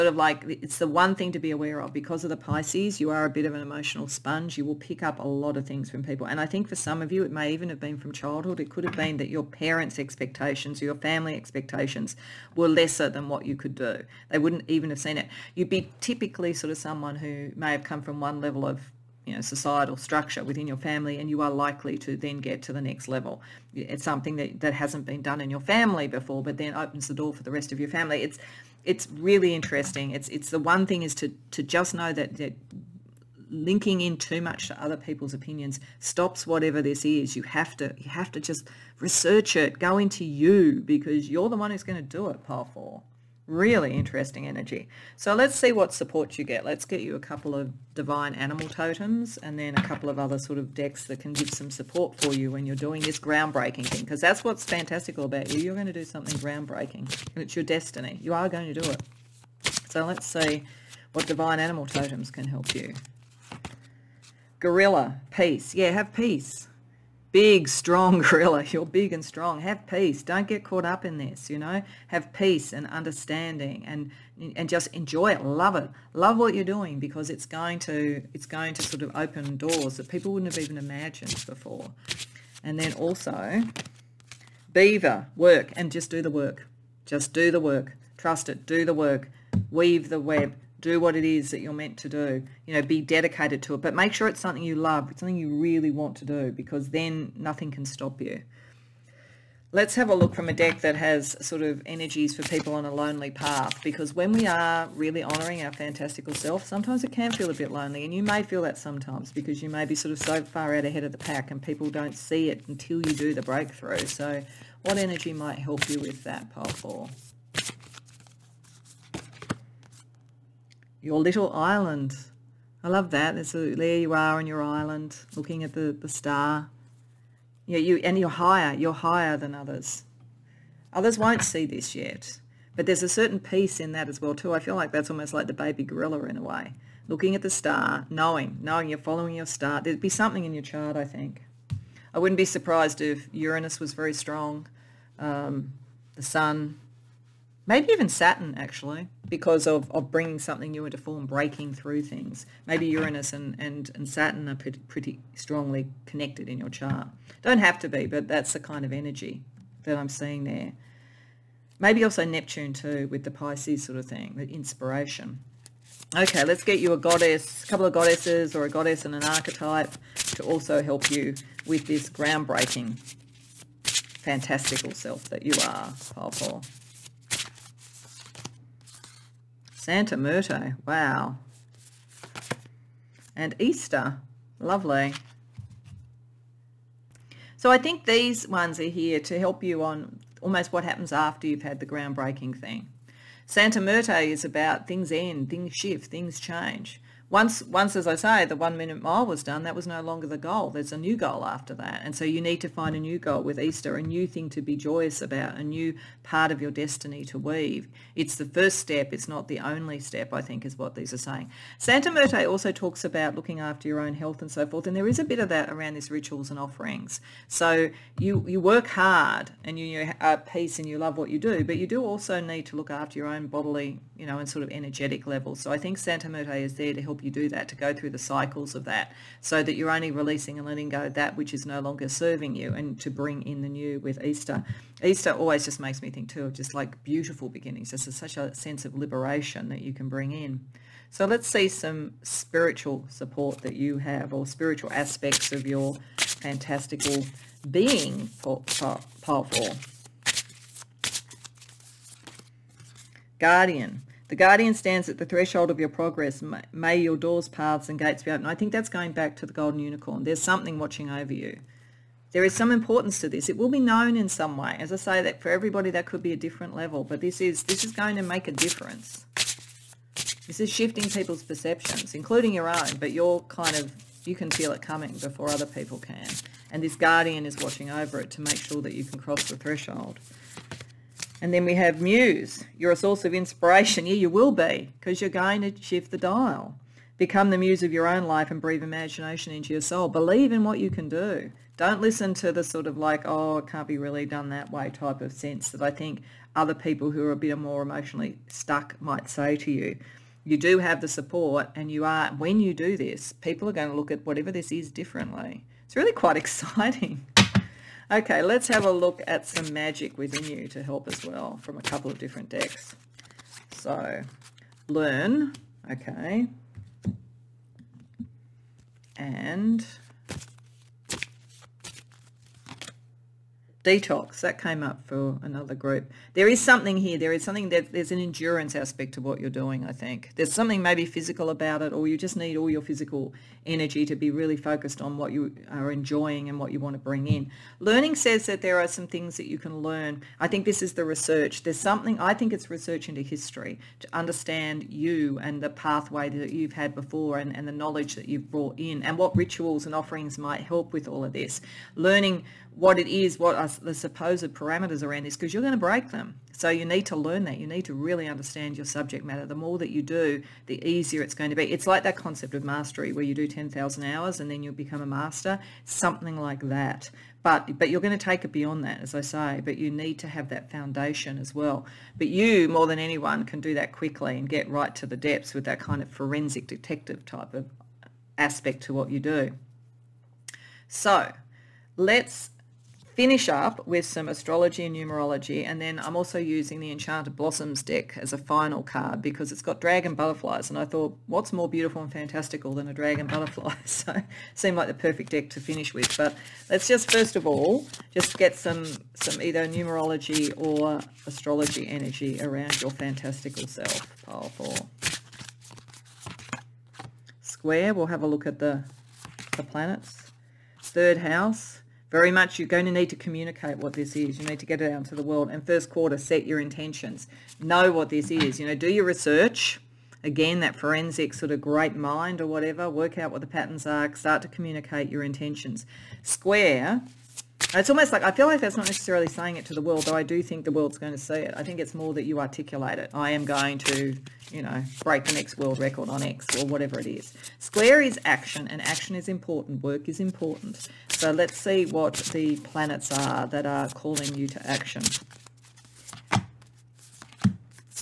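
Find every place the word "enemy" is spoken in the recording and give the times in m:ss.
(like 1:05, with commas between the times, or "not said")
not said.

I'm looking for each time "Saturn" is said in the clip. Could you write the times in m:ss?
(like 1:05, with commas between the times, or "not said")
2:28, 2:34.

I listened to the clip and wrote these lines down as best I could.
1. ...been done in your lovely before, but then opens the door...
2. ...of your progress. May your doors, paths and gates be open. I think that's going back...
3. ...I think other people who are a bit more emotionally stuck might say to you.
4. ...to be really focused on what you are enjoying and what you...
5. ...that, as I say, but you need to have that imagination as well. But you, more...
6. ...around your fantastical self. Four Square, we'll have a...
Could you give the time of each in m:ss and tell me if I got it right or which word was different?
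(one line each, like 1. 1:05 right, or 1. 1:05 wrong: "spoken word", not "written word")
1. 0:25 wrong: "family", not "lovely"
2. 4:15 right
3. 4:55 right
4. 5:34 right
5. 6:08 wrong: "foundation", not "imagination"
6. 6:42 right.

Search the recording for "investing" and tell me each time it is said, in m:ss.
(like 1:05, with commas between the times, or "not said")
not said.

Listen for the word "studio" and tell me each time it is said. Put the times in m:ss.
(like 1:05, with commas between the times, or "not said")
not said.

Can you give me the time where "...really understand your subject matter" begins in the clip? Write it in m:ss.
5:57.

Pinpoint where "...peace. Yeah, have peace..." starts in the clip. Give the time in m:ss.
1:05.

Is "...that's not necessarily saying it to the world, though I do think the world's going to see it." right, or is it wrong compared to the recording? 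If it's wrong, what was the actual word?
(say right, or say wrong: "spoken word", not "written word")
right.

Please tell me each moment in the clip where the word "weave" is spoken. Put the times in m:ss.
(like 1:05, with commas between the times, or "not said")
1:29, 3:27.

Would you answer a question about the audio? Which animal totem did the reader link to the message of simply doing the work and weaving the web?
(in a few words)
Beaver.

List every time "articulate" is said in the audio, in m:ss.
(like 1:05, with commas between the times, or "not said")
7:12.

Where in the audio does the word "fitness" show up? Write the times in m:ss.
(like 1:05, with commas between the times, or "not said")
not said.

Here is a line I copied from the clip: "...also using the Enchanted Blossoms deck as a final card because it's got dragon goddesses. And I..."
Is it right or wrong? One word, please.
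wrong.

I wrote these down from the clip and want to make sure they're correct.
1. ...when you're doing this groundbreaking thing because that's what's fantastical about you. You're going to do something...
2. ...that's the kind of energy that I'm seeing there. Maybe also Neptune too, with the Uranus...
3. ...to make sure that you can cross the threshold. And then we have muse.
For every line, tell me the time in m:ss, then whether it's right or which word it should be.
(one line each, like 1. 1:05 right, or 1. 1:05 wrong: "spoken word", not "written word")
1. 0:52 right
2. 2:38 wrong: "Pisces", not "Uranus"
3. 4:38 right.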